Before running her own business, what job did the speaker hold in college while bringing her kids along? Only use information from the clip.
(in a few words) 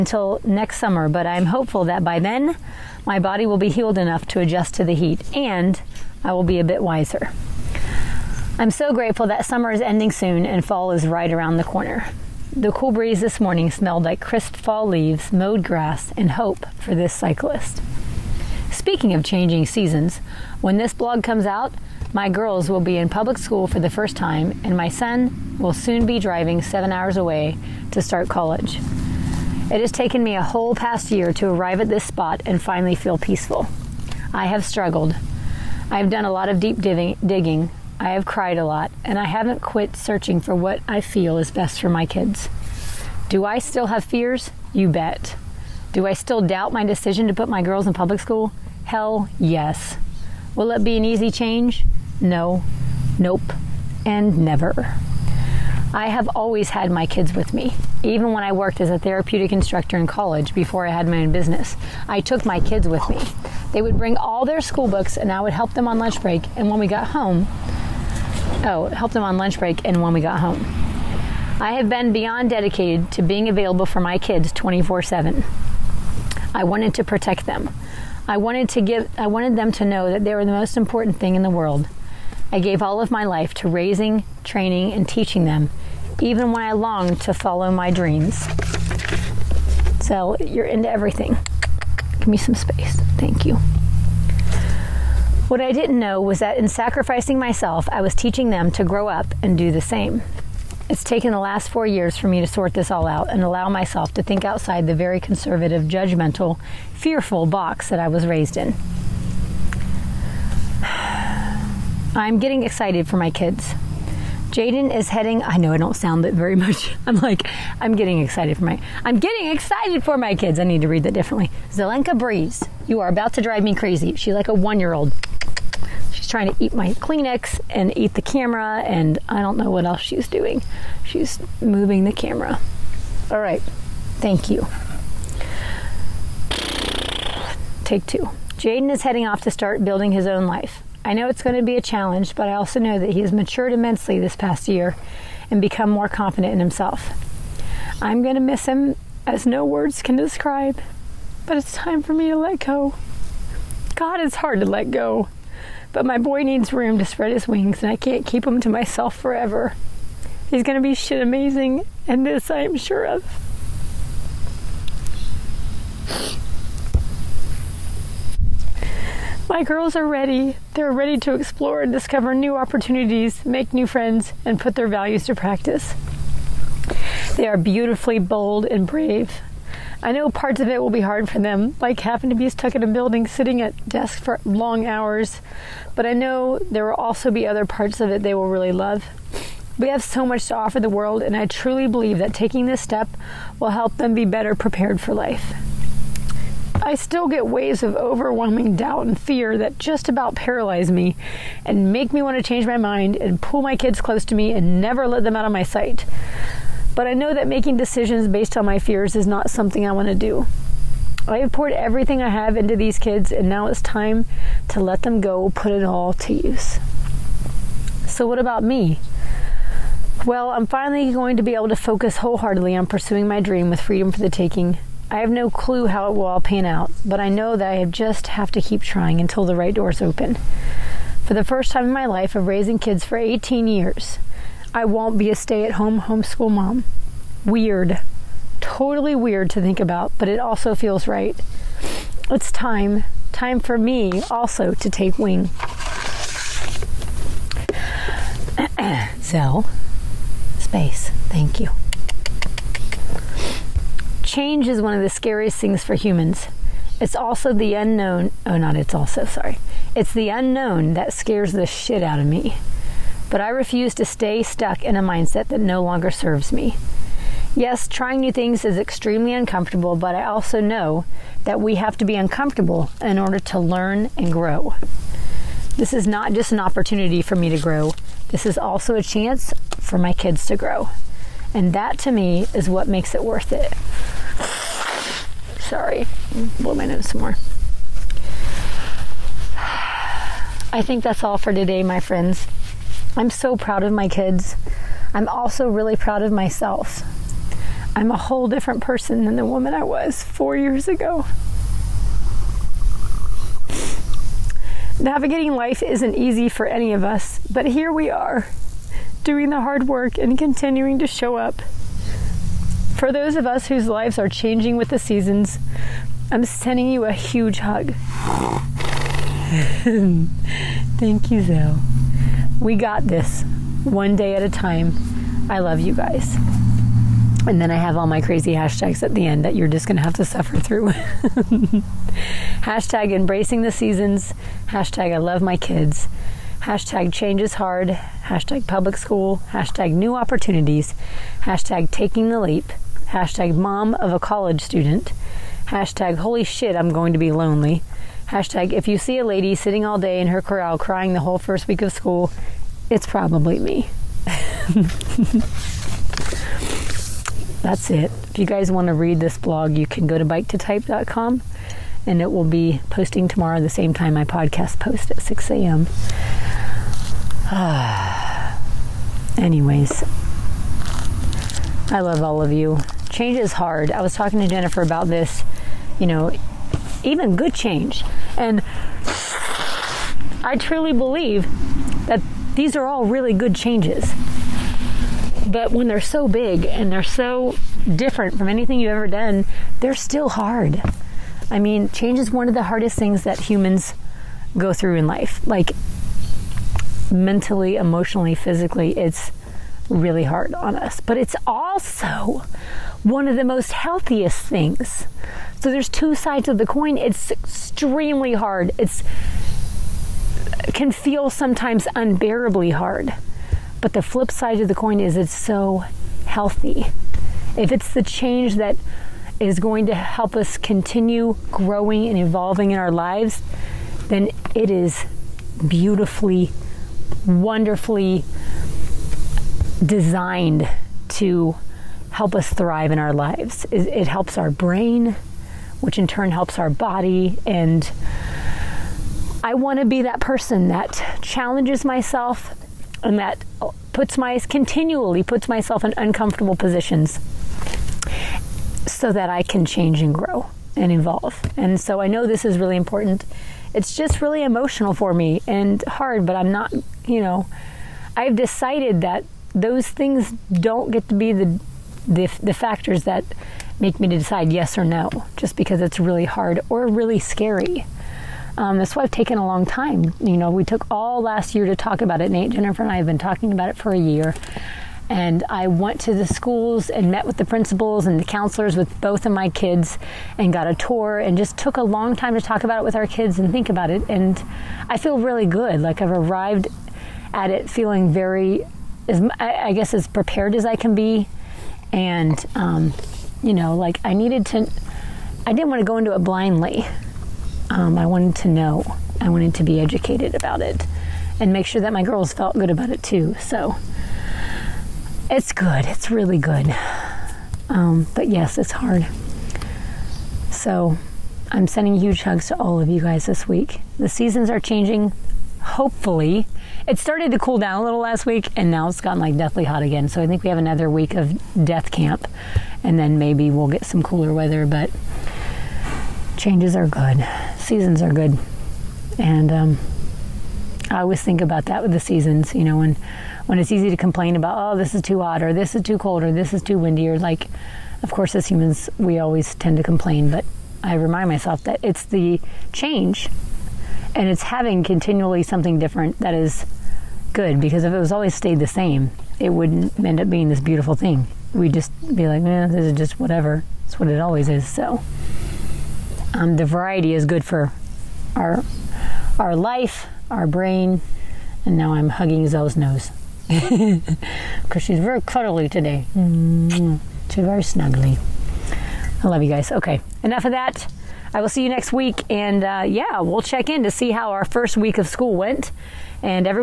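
Therapeutic instructor.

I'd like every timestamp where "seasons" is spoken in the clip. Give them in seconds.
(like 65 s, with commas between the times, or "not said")
19 s, 314 s, 333 s, 514 s, 527 s, 532 s.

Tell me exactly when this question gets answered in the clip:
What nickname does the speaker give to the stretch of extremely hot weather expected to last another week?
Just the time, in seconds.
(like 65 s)
521 s.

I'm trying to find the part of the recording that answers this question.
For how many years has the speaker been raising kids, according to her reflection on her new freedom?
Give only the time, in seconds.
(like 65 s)
233 s.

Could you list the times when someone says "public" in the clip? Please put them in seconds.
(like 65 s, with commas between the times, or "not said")
23 s, 47 s, 338 s.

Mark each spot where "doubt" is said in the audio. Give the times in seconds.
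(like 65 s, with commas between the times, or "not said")
46 s, 198 s.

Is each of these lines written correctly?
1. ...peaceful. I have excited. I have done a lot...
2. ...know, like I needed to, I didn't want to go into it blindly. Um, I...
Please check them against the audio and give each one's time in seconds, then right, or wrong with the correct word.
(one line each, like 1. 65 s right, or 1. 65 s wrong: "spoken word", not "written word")
1. 33 s wrong: "struggled", not "excited"
2. 493 s right.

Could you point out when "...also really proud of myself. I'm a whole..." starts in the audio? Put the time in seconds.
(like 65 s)
295 s.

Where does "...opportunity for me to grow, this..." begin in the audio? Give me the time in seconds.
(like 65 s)
276 s.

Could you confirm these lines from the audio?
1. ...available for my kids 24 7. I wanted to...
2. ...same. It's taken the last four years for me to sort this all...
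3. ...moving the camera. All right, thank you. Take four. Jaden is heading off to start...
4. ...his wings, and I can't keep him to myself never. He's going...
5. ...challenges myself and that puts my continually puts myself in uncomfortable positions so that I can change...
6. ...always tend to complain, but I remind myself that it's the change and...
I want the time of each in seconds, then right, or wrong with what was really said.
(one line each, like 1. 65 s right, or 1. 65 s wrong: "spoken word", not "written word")
1. 73 s right
2. 99 s right
3. 131 s wrong: "two", not "four"
4. 157 s wrong: "forever", not "never"
5. 441 s right
6. 539 s right.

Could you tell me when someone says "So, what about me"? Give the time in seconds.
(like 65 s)
218 s.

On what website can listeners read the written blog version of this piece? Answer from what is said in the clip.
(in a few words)
biketotype.com.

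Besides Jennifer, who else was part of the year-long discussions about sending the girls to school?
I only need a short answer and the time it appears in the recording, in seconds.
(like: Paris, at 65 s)
Nate, at 472 s.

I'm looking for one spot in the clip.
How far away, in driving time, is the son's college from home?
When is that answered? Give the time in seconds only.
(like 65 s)
26 s.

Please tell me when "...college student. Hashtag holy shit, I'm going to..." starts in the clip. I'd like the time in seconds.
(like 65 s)
344 s.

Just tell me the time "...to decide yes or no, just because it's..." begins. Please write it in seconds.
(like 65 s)
464 s.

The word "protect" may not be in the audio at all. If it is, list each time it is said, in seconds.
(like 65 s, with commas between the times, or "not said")
77 s.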